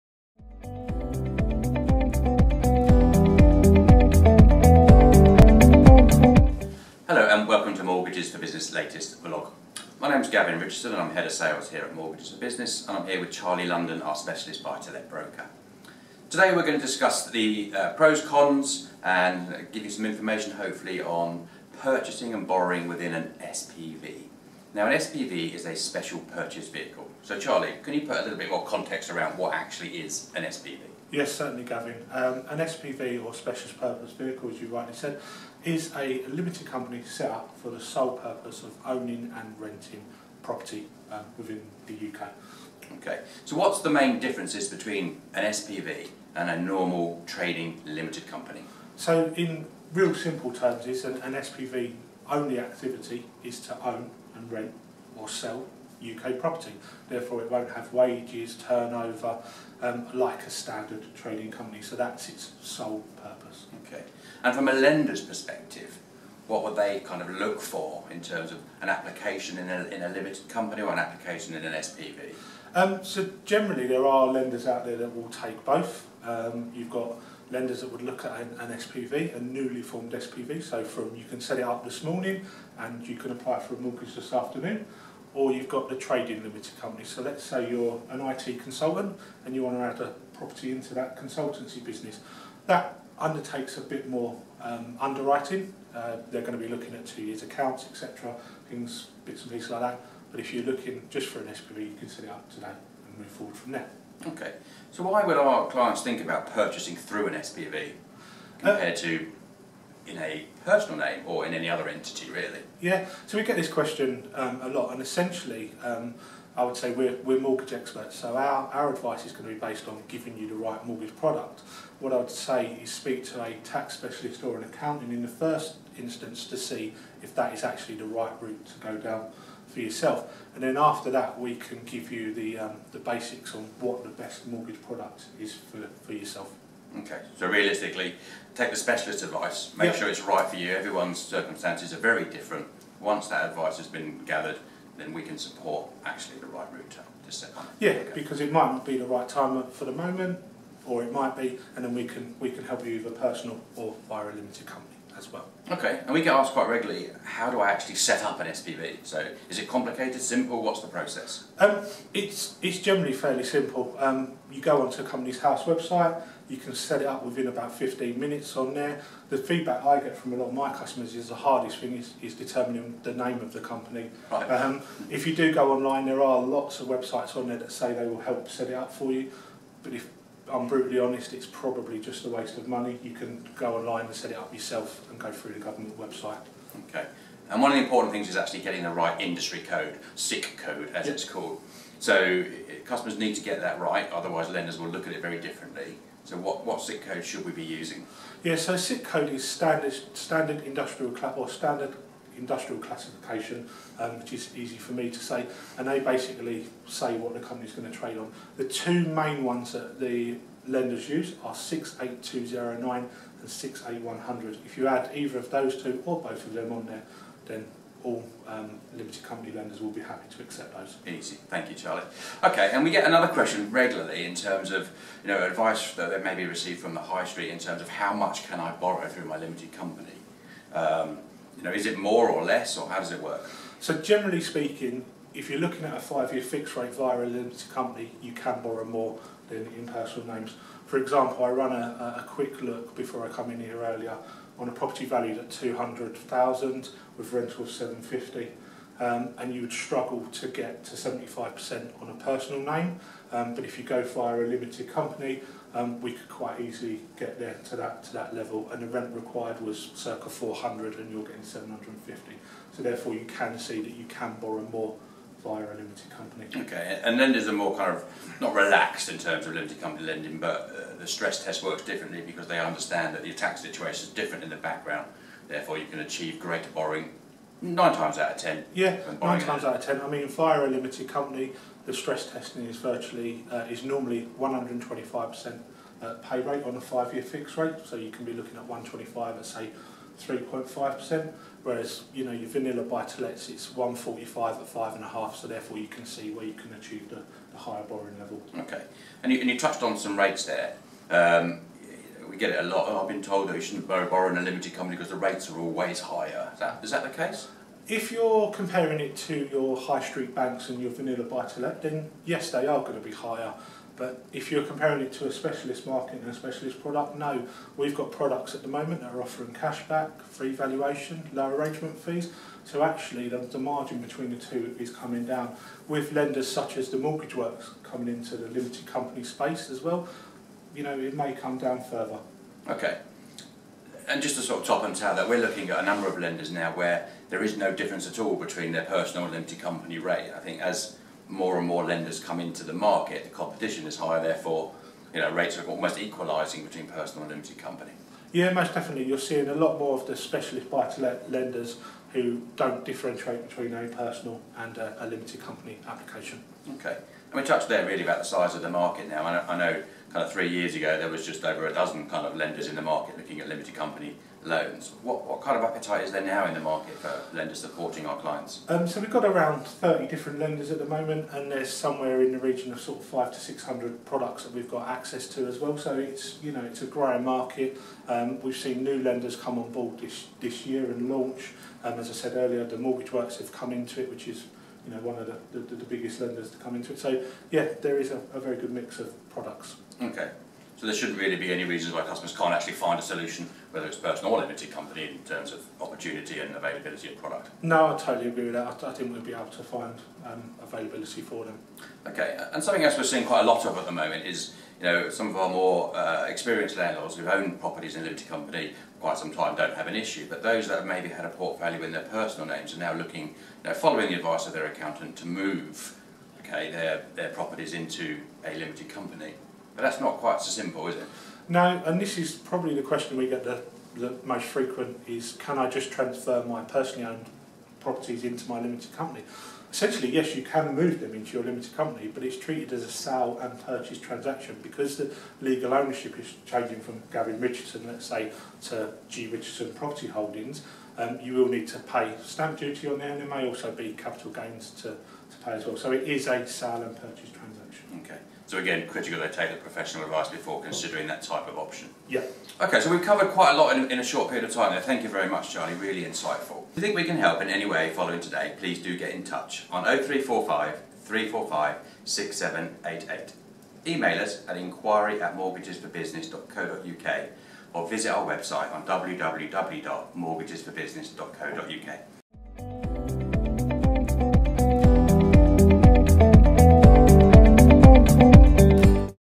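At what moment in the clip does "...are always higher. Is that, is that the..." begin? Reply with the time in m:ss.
5:05.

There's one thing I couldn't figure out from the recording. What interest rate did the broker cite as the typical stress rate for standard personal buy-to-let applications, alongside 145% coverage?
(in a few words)
five and a half.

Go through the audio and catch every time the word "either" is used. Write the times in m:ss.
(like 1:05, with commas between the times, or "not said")
2:32, 3:35.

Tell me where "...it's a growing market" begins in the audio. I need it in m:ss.
6:16.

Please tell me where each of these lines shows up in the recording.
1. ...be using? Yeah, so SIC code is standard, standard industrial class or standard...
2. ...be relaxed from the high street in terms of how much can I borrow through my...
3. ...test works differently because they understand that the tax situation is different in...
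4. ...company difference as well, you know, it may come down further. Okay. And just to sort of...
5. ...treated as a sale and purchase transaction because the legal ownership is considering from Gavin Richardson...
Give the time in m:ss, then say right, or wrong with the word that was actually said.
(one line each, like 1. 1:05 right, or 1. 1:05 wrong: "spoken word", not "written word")
1. 3:17 right
2. 3:46 wrong: "received", not "relaxed"
3. 4:31 right
4. 5:28 wrong: "space", not "difference"
5. 7:12 wrong: "changing", not "considering".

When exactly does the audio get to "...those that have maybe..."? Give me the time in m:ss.
6:50.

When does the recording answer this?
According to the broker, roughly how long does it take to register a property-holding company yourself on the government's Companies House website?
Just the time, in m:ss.
2:47.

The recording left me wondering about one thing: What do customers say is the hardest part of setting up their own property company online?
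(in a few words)
the name of the company.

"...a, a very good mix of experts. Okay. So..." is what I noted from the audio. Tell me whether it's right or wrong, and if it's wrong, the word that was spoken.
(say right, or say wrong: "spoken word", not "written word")
wrong: "products", not "experts".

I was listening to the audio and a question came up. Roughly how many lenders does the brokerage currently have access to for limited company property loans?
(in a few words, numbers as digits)
around 30.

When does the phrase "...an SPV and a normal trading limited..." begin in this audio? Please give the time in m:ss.
0:45.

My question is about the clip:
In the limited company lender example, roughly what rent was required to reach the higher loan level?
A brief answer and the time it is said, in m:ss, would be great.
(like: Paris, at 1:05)
circa 400, at 4:19.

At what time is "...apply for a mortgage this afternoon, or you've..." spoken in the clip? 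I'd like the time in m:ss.
1:23.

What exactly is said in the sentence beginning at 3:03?
You can go online and set it up yourself and go through the government website.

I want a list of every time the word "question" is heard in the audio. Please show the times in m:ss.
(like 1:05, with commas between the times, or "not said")
1:53, 3:43, 7:02.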